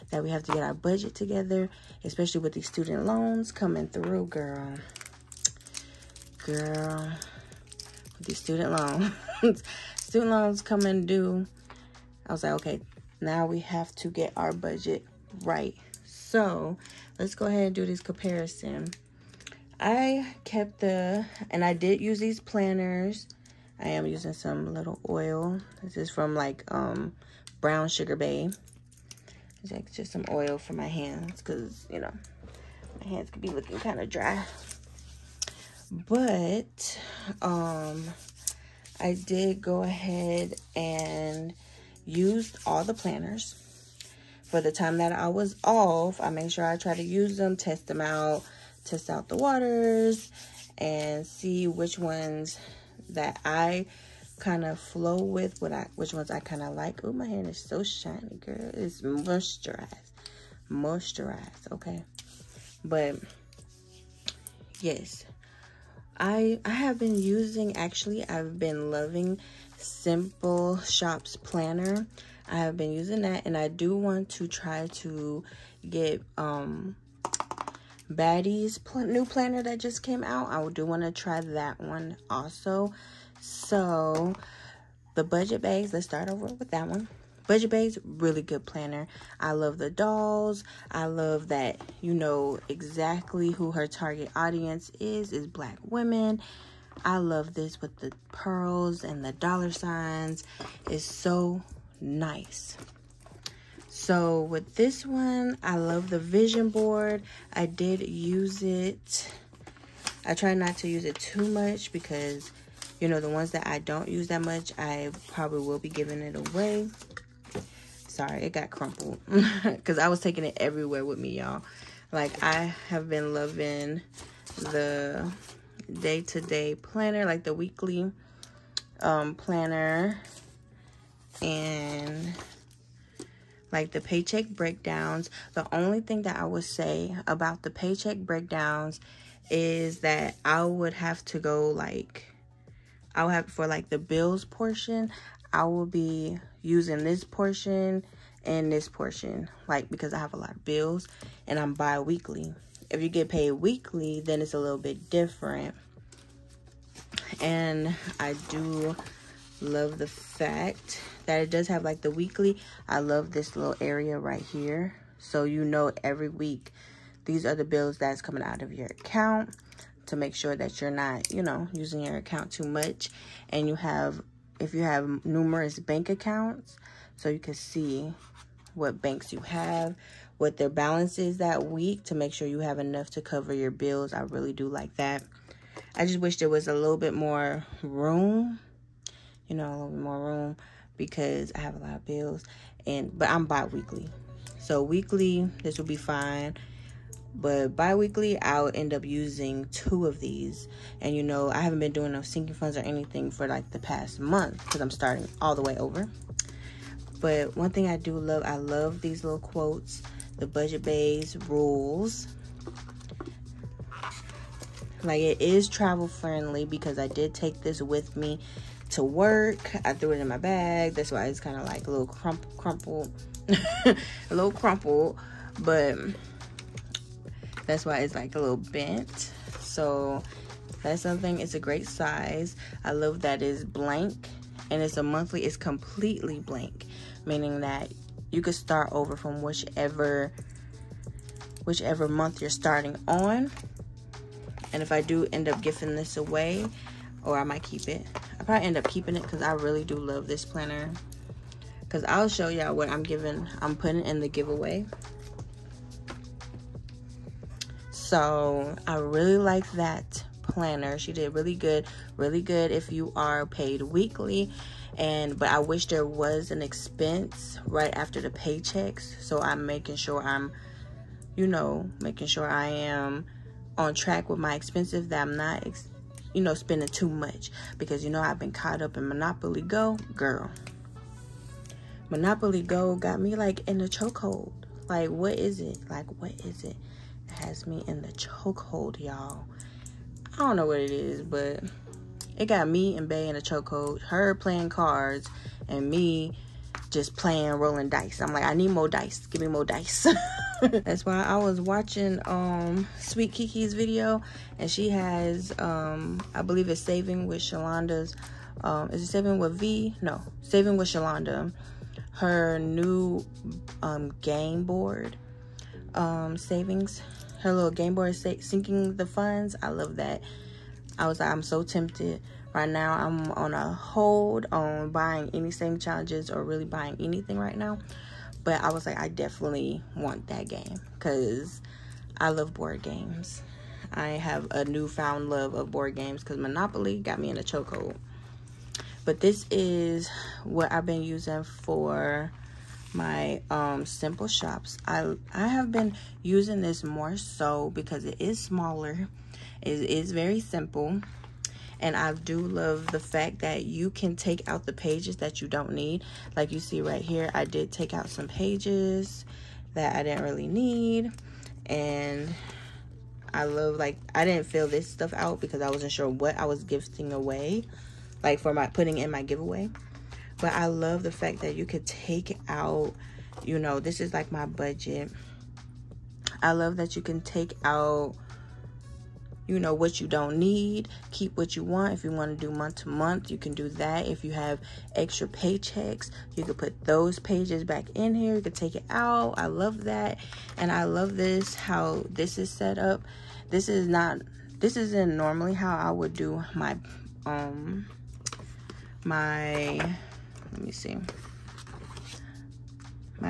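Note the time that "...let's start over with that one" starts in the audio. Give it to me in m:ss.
1:25.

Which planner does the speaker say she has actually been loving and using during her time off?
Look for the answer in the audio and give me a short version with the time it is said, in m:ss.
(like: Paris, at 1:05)
Simple Shops Planner, at 1:09.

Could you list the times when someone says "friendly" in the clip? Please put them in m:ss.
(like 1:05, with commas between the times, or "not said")
3:36.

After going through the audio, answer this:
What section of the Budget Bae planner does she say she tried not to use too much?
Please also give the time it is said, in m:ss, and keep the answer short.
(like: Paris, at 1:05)
vision board, at 1:46.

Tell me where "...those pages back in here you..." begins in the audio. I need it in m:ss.
6:26.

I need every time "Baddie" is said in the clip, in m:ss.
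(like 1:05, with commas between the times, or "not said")
1:18.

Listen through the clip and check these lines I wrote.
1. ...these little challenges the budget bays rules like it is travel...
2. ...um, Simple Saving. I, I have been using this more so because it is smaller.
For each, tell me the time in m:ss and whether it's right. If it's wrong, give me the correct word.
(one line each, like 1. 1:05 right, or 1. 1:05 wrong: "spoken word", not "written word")
1. 3:28 wrong: "quotes", not "challenges"
2. 5:43 wrong: "Shops", not "Saving".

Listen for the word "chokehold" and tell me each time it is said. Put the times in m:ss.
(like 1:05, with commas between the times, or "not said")
4:43, 4:48, 4:53, 5:37.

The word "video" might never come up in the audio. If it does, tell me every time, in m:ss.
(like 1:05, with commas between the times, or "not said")
5:03.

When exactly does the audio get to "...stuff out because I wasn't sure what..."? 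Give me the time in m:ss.
6:04.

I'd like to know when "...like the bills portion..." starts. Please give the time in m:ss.
2:23.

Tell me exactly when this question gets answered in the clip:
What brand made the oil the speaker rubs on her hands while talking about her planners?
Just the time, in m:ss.
0:27.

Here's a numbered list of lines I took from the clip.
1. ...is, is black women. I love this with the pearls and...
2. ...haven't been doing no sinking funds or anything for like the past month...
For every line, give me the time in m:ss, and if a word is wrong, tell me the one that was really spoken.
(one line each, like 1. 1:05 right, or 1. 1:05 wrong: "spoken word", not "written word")
1. 1:34 right
2. 3:21 right.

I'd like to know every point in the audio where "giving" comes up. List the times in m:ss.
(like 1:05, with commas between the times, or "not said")
1:55, 4:05, 4:13.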